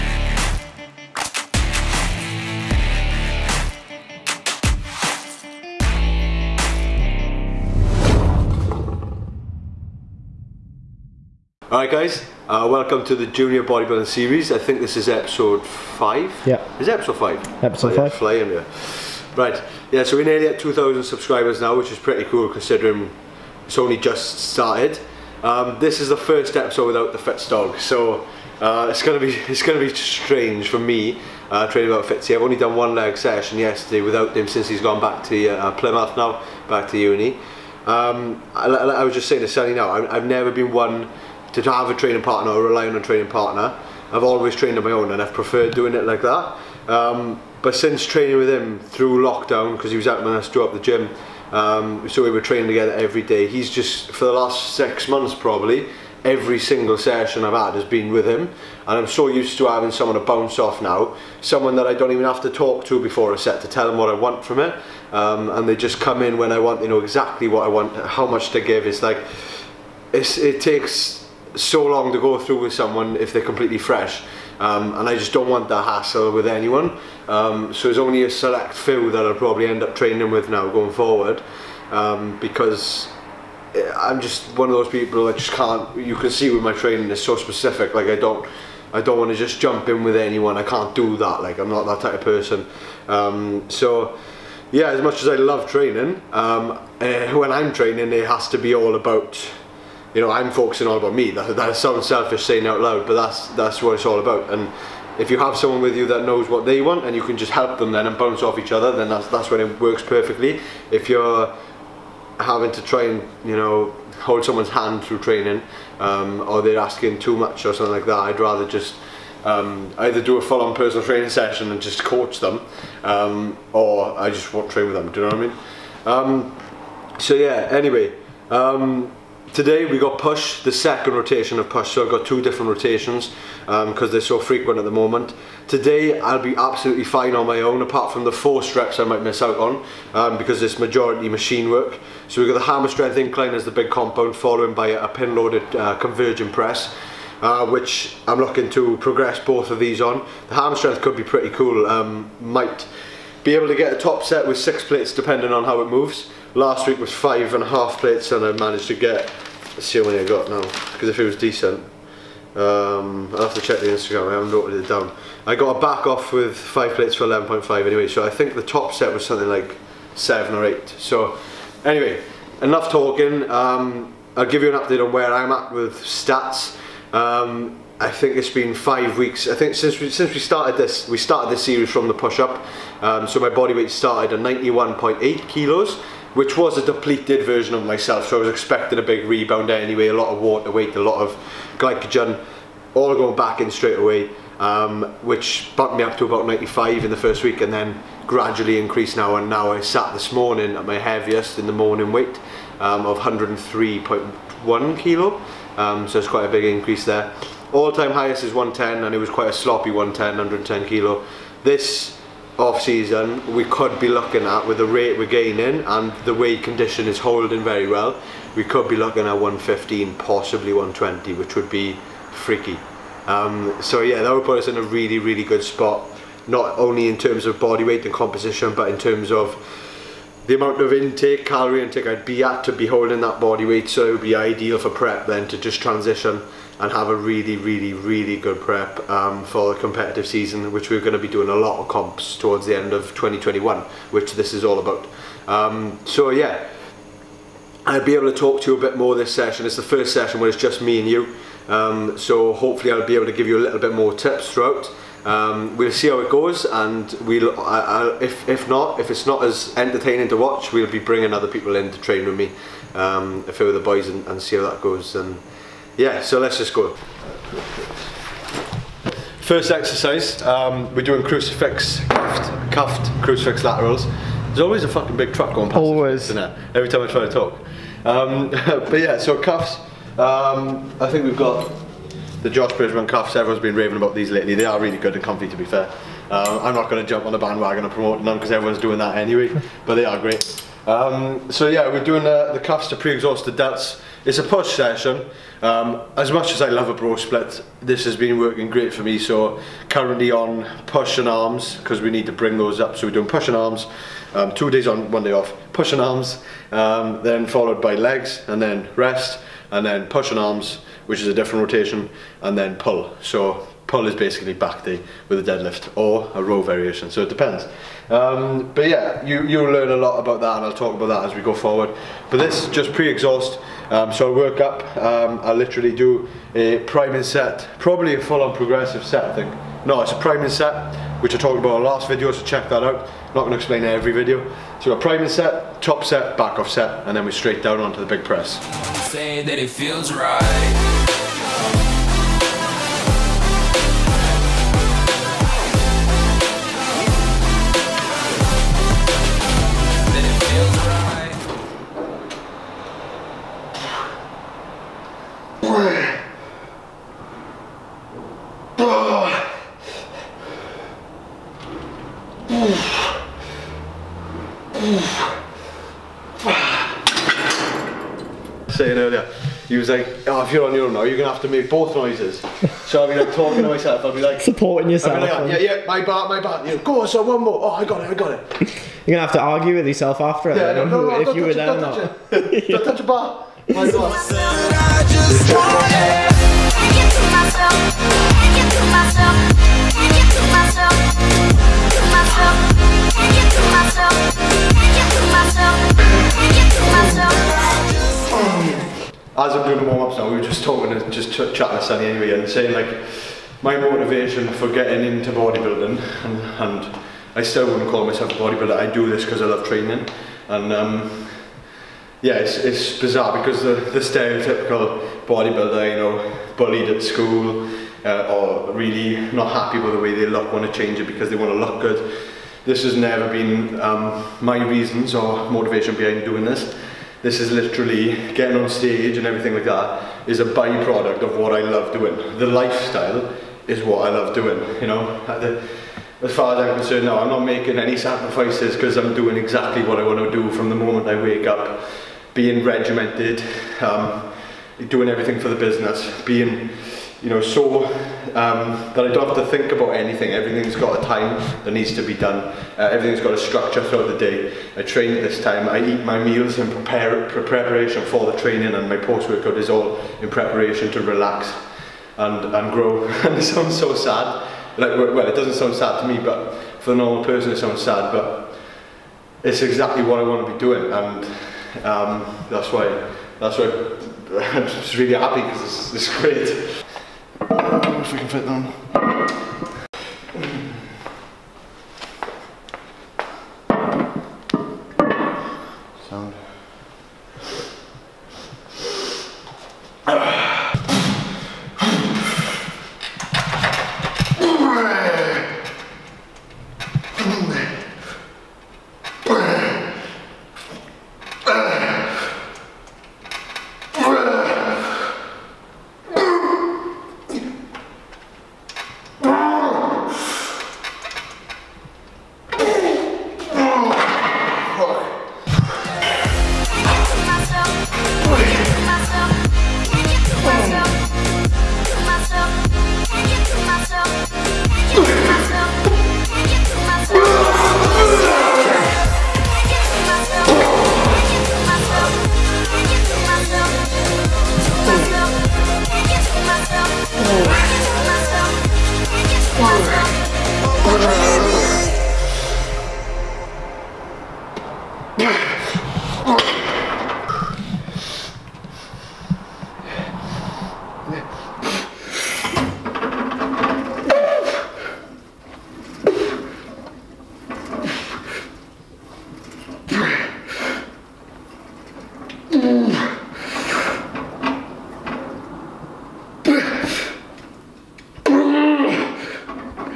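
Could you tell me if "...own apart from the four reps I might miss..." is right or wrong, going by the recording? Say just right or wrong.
right.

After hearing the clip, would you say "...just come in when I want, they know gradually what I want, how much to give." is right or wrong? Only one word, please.
wrong.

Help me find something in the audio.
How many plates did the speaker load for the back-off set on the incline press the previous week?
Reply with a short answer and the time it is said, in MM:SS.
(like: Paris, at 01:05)
5, at 02:46.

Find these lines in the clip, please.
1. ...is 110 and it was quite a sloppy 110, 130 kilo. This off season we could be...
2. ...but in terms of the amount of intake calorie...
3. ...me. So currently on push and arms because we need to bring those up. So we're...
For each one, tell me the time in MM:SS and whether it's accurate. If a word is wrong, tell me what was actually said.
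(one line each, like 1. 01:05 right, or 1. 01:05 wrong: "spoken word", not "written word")
1. 03:28 wrong: "110", not "130"
2. 03:48 right
3. 04:59 right.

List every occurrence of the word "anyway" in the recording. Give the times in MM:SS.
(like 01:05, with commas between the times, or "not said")
02:07, 02:47, 02:51, 03:09, 04:49, 06:42.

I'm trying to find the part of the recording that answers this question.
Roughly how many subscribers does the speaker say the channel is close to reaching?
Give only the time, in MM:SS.
00:20.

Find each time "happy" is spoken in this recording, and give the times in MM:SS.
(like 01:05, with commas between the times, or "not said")
06:59, 07:55.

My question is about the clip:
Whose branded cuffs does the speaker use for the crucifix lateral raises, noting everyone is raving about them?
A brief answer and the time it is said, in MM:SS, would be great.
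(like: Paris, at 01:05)
Josh Bridgman, at 04:42.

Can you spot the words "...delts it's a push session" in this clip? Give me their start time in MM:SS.
04:53.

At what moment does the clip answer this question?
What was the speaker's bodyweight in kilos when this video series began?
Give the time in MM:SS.
03:04.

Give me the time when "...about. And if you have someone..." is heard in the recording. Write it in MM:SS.
01:44.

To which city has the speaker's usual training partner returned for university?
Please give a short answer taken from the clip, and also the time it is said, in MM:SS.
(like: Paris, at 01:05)
Plymouth, at 00:35.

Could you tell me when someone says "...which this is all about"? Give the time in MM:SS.
04:04.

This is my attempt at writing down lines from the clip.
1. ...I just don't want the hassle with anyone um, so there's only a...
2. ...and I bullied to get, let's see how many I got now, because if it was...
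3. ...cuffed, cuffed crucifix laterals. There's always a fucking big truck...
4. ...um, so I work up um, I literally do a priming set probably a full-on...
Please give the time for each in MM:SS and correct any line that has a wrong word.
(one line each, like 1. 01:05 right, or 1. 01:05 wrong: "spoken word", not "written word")
1. 01:15 right
2. 02:38 wrong: "managed", not "bullied"
3. 04:32 right
4. 05:23 right.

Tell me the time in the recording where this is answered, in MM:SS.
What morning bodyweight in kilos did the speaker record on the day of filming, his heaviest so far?
03:23.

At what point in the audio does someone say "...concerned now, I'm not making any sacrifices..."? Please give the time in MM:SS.
07:16.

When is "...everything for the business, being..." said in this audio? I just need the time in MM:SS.
07:25.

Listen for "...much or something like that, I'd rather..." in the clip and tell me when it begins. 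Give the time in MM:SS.
01:57.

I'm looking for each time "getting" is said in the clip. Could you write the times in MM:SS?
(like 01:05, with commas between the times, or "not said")
06:44, 07:08.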